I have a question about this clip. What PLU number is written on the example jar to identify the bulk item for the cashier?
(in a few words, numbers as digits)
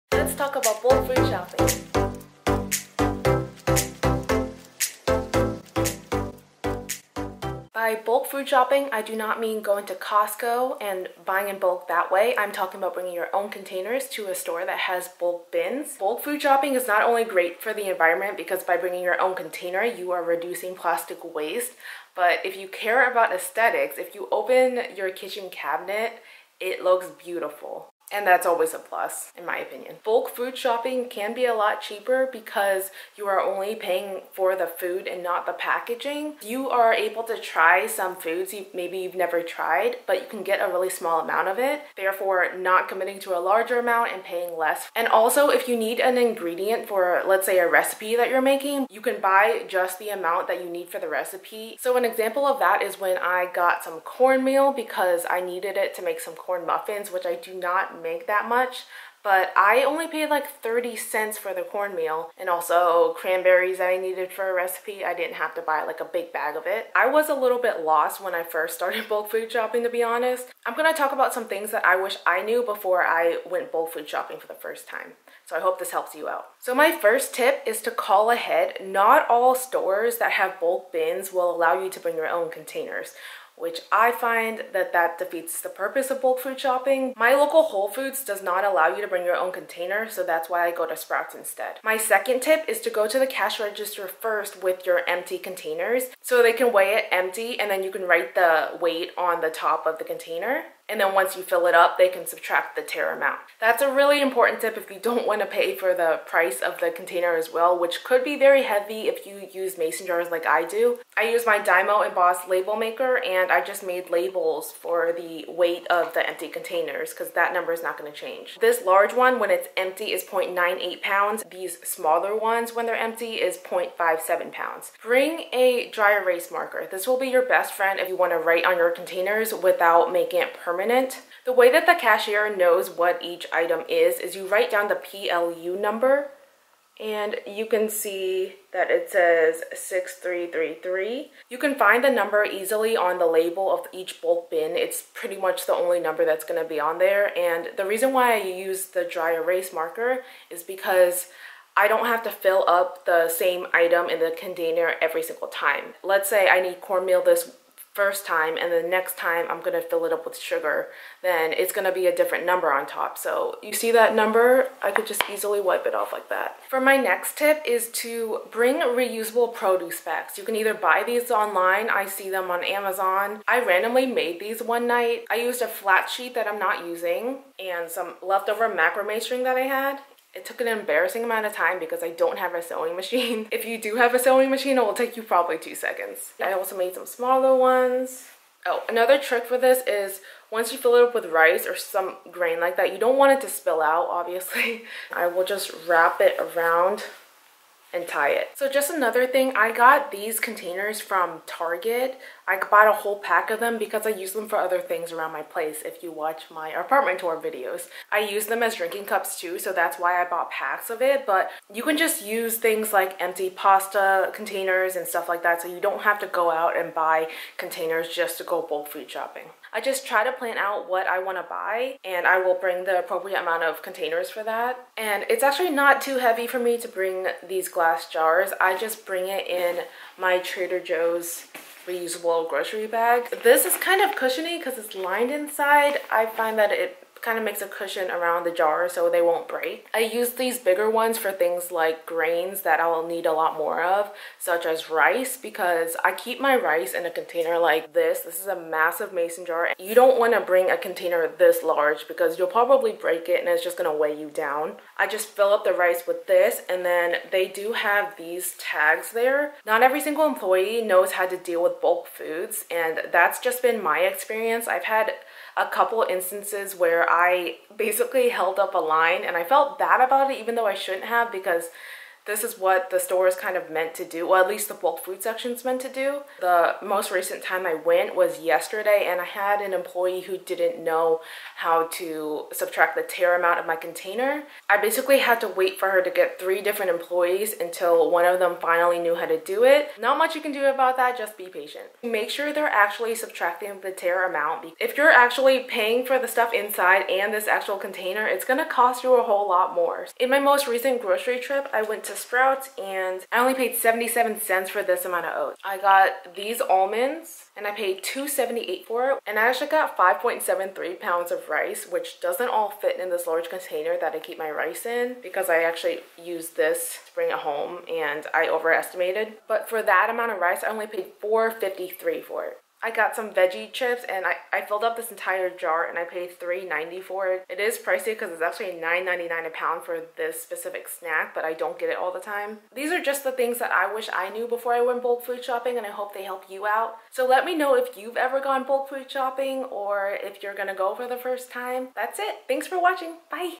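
6333.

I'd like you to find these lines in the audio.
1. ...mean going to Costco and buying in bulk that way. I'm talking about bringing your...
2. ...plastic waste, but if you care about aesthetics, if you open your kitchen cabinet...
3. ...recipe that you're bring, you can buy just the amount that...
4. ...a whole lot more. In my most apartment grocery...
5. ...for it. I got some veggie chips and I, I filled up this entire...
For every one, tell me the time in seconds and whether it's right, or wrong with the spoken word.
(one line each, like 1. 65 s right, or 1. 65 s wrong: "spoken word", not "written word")
1. 9 s right
2. 20 s right
3. 47 s wrong: "making", not "bring"
4. 299 s wrong: "recent", not "apartment"
5. 322 s right.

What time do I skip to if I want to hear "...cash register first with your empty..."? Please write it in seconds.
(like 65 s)
93 s.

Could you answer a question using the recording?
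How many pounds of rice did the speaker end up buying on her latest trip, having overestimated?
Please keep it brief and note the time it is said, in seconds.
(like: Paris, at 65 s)
5.73 pounds, at 309 s.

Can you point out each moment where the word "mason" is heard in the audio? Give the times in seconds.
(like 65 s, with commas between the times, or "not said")
109 s, 249 s.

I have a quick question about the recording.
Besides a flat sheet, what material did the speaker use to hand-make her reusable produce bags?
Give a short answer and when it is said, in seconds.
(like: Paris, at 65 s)
macrame string, at 178 s.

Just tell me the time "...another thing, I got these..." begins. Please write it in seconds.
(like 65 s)
198 s.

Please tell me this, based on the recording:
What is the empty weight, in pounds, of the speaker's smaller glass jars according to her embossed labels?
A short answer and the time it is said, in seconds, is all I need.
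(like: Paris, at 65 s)
0.57 pounds, at 123 s.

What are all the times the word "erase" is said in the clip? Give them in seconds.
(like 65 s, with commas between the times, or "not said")
126 s, 149 s.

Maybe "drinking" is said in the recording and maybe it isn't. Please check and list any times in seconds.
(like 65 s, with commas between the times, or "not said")
208 s.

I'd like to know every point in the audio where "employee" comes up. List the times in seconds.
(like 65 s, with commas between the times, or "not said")
260 s, 279 s, 286 s.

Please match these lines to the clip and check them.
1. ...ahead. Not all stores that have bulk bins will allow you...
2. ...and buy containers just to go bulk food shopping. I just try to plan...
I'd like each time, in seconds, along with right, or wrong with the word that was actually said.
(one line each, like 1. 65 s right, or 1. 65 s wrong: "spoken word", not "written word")
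1. 78 s right
2. 216 s right.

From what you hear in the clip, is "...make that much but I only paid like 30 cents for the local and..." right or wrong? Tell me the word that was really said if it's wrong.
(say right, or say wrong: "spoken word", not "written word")
wrong: "cornmeal", not "local".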